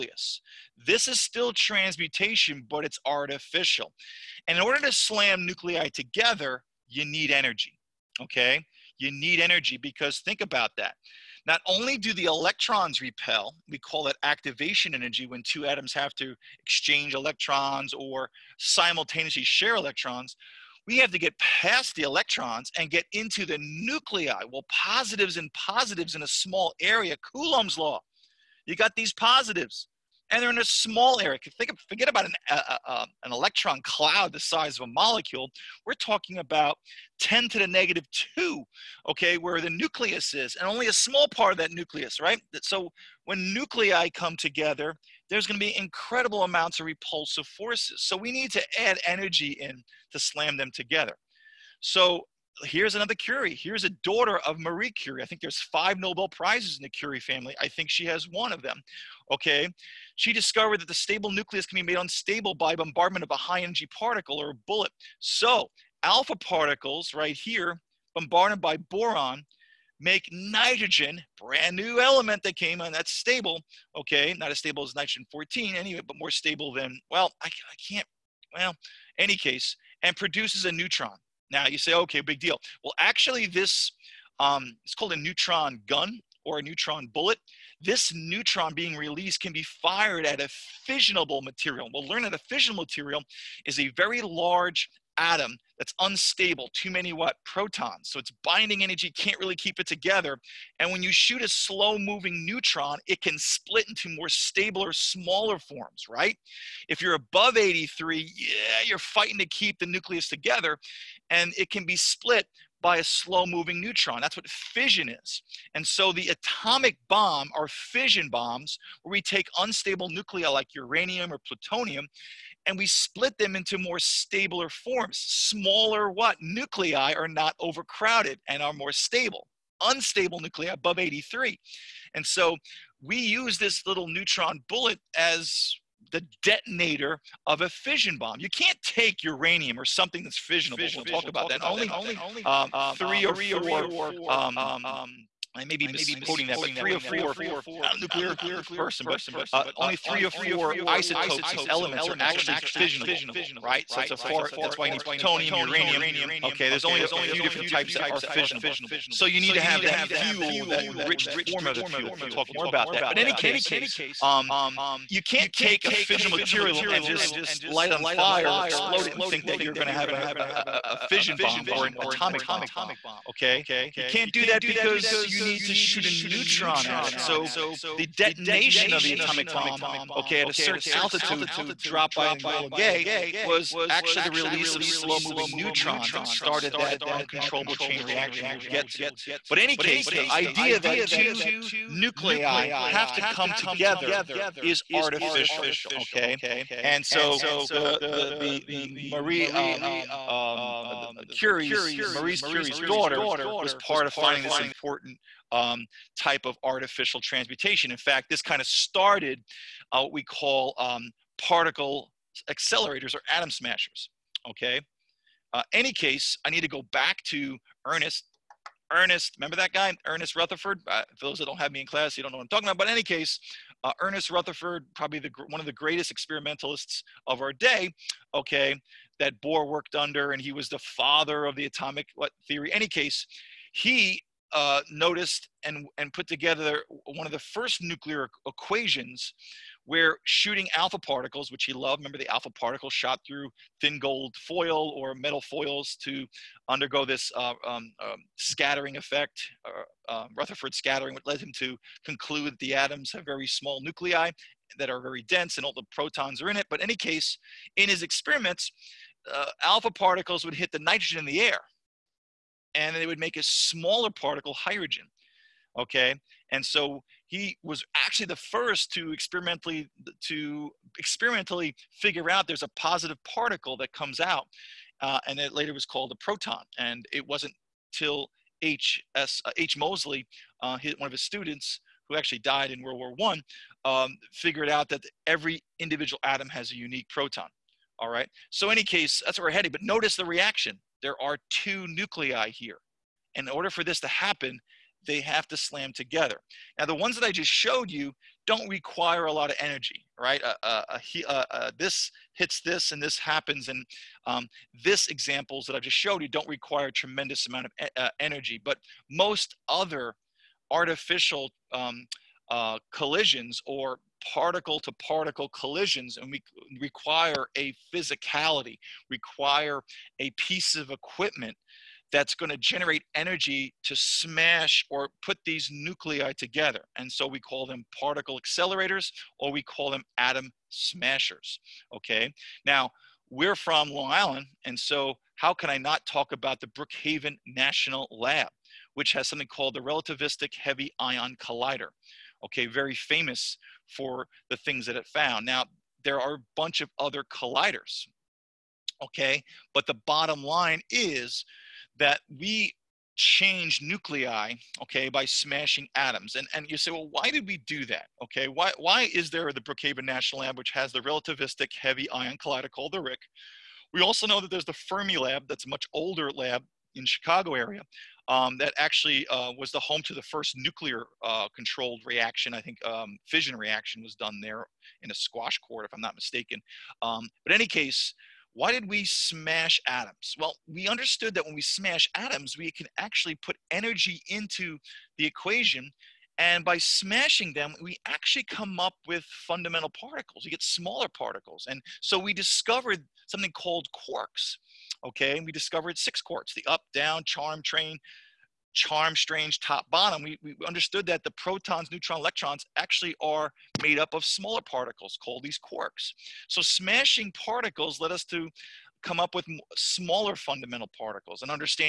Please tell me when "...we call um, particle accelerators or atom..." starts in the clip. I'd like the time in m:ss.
3:30.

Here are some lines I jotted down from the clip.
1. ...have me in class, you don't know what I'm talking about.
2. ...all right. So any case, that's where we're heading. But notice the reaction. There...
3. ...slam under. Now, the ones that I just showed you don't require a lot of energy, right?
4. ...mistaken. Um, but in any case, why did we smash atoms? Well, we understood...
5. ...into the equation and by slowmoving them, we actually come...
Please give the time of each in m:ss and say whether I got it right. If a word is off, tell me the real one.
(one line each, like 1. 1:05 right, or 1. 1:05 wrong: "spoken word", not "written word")
1. 3:41 right
2. 4:47 right
3. 4:55 wrong: "together", not "under"
4. 6:16 right
5. 6:24 wrong: "smashing", not "slowmoving".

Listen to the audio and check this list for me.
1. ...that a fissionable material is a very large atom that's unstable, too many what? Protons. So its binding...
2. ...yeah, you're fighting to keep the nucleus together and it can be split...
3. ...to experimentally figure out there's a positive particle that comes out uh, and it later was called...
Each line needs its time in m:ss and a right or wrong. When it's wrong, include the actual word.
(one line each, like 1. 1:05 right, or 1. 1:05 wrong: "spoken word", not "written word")
1. 1:32 right
2. 1:48 right
3. 4:30 right.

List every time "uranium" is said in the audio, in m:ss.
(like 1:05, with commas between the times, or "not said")
2:00, 2:19, 2:35.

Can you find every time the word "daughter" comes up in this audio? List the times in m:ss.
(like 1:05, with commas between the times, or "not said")
0:54, 3:22.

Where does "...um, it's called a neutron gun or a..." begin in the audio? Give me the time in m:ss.
1:24.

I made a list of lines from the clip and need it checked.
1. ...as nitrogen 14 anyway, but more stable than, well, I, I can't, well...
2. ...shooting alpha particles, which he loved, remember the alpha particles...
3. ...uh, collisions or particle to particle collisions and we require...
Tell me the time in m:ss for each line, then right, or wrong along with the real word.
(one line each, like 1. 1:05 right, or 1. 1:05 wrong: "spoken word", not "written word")
1. 1:14 right
2. 4:00 right
3. 5:12 right.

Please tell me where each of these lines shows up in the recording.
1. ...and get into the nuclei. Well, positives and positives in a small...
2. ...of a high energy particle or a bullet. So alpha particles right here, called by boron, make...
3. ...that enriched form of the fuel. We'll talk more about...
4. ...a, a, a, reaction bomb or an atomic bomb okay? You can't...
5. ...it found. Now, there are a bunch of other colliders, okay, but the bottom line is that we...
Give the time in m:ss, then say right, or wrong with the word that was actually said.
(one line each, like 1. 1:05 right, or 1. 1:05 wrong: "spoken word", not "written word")
1. 0:22 right
2. 1:03 wrong: "bombarded", not "called"
3. 2:40 right
4. 2:50 wrong: "fission", not "reaction"
5. 5:44 right.